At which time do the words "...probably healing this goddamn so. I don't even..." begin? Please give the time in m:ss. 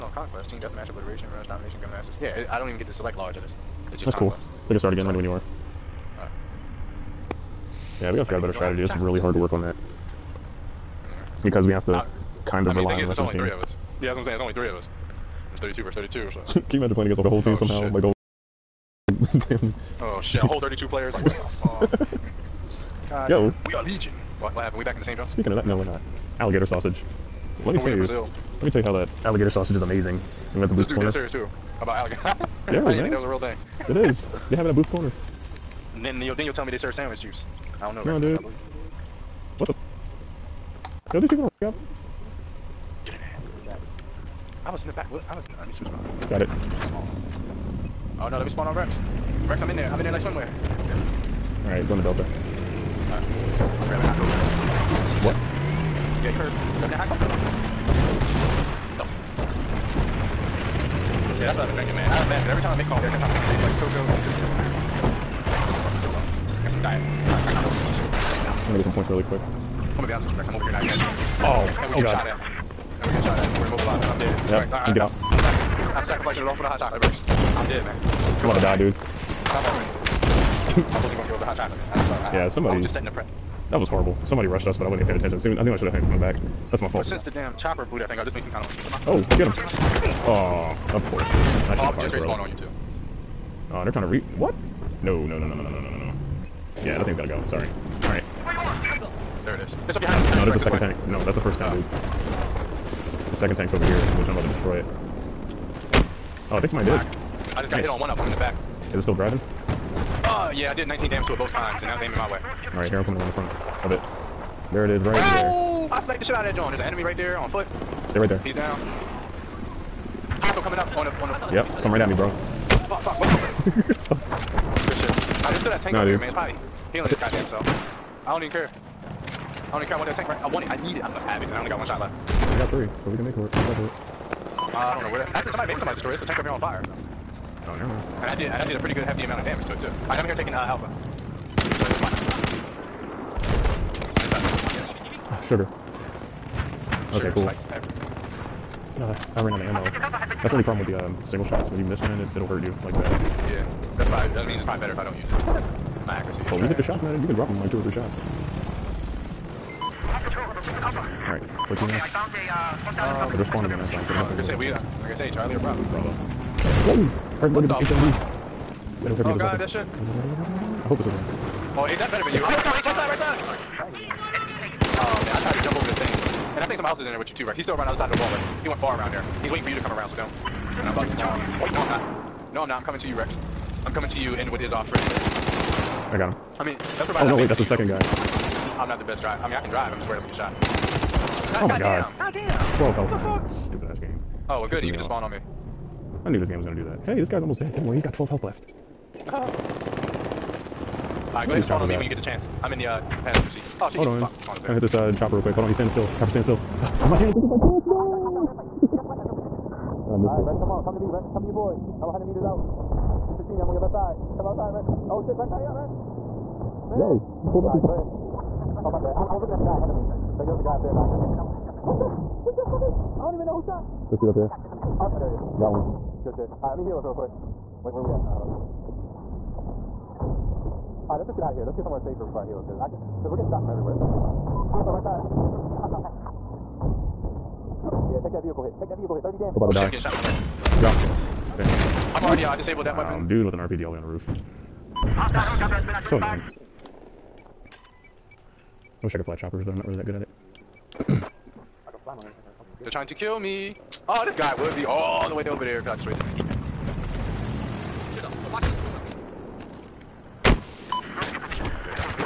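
2:06.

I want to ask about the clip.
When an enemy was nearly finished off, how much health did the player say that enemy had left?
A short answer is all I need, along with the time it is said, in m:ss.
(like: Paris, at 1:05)
12, at 3:18.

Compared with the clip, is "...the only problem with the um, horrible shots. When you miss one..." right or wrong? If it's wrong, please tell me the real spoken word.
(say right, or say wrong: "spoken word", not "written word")
wrong: "single", not "horrible".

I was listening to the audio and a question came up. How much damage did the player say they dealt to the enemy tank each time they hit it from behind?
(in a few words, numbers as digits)
19.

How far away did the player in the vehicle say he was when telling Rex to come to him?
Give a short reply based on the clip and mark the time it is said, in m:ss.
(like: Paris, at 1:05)
100 meters, at 3:32.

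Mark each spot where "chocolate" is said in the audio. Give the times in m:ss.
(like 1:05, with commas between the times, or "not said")
1:16, 1:21.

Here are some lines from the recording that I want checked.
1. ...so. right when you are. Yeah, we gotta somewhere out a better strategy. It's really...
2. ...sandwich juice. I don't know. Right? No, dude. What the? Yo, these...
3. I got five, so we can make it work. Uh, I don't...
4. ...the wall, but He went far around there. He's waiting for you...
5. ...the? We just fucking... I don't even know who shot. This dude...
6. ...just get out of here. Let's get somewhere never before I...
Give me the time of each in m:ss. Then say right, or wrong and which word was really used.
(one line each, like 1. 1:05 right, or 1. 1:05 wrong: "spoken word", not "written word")
1. 0:05 wrong: "figure", not "somewhere"
2. 0:36 right
3. 2:12 wrong: "three", not "five"
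4. 2:58 right
5. 3:41 right
6. 3:51 wrong: "safer", not "never".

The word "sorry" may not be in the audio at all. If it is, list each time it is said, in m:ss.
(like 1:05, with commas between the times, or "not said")
1:22, 1:37.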